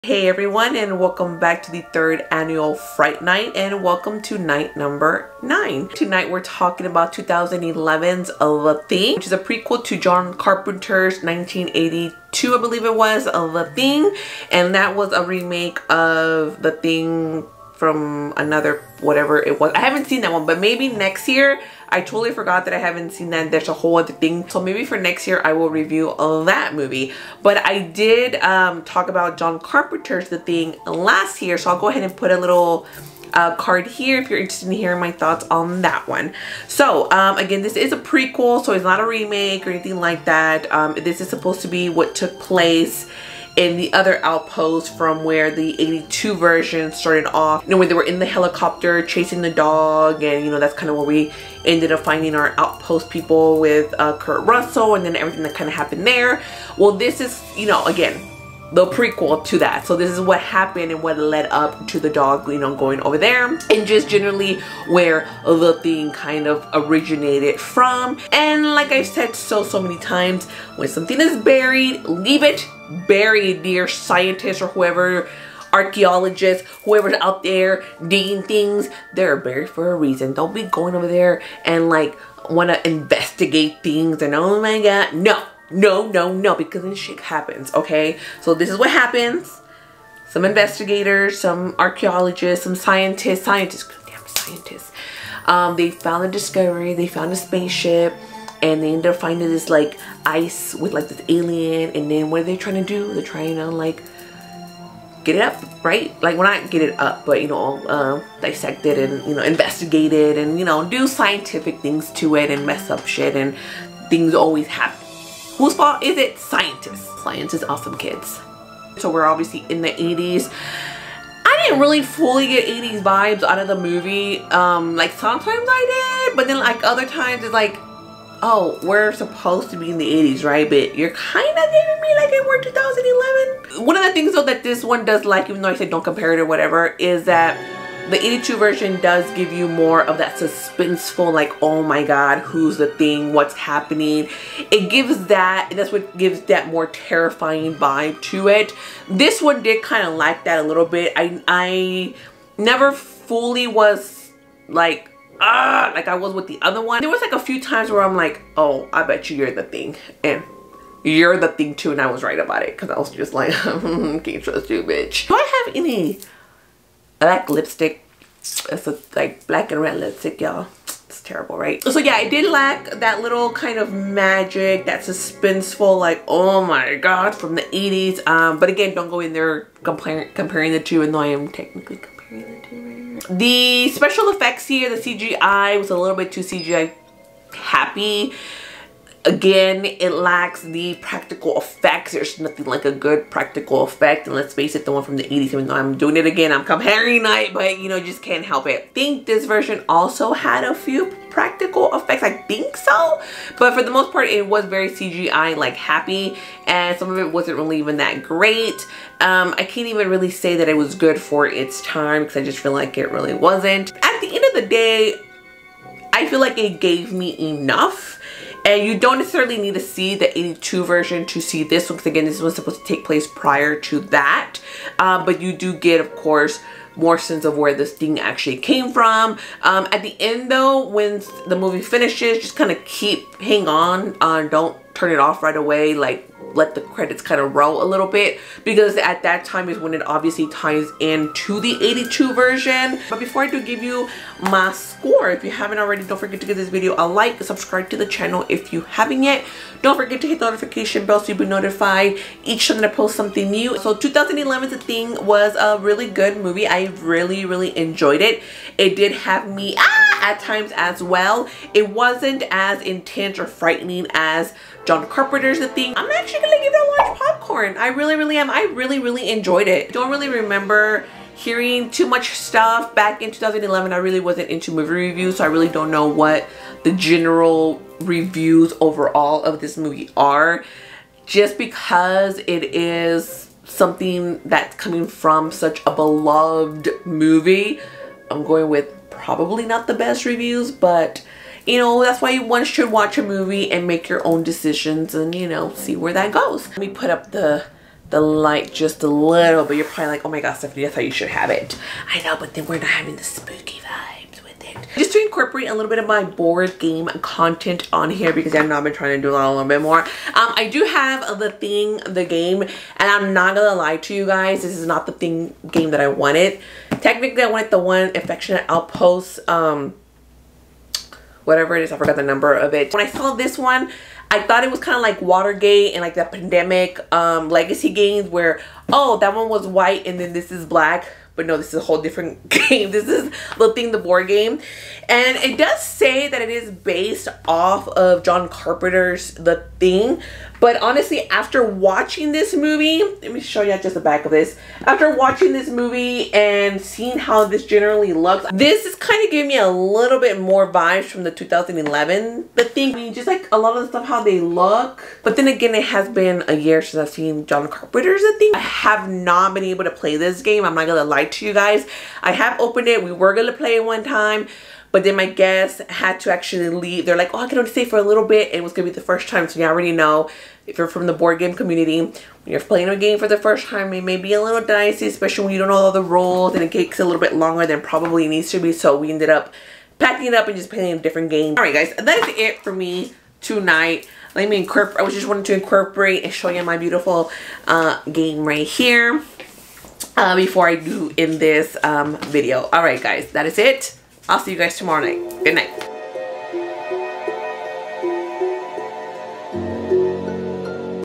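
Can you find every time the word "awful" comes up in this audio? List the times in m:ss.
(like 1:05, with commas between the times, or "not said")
not said.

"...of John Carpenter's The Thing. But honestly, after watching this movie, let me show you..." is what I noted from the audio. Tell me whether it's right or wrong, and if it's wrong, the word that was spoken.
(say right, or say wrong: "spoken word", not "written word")
right.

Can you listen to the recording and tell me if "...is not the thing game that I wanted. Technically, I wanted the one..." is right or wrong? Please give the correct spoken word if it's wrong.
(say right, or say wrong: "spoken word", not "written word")
right.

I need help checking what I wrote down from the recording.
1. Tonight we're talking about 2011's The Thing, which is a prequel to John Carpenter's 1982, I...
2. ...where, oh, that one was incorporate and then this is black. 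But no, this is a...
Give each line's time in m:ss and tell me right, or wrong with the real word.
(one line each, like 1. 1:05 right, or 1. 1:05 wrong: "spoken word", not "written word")
1. 0:05 right
2. 5:28 wrong: "white", not "incorporate".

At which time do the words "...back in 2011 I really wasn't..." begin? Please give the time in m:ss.
4:32.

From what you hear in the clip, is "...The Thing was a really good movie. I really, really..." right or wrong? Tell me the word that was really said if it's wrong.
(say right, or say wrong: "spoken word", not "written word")
right.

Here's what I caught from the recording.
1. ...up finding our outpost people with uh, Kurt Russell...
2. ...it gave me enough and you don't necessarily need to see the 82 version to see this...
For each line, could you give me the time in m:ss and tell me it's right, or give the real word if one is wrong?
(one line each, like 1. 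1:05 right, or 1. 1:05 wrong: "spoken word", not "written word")
1. 0:51 right
2. 3:36 right.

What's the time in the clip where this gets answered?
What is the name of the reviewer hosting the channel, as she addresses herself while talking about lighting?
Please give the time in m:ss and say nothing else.
5:00.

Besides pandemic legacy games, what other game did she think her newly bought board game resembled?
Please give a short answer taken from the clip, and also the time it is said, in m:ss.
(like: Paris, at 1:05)
Watergate, at 5:25.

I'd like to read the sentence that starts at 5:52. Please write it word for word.
I mean, just like a lot of the stuff, how they look.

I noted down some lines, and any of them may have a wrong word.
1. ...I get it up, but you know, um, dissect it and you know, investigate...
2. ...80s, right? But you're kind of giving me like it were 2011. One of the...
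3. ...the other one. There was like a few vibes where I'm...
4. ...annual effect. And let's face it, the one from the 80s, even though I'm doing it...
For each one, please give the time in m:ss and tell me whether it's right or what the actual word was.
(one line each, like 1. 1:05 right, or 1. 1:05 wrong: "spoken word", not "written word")
1. 1:46 right
2. 2:10 right
3. 2:36 wrong: "times", not "vibes"
4. 3:13 wrong: "practical", not "annual".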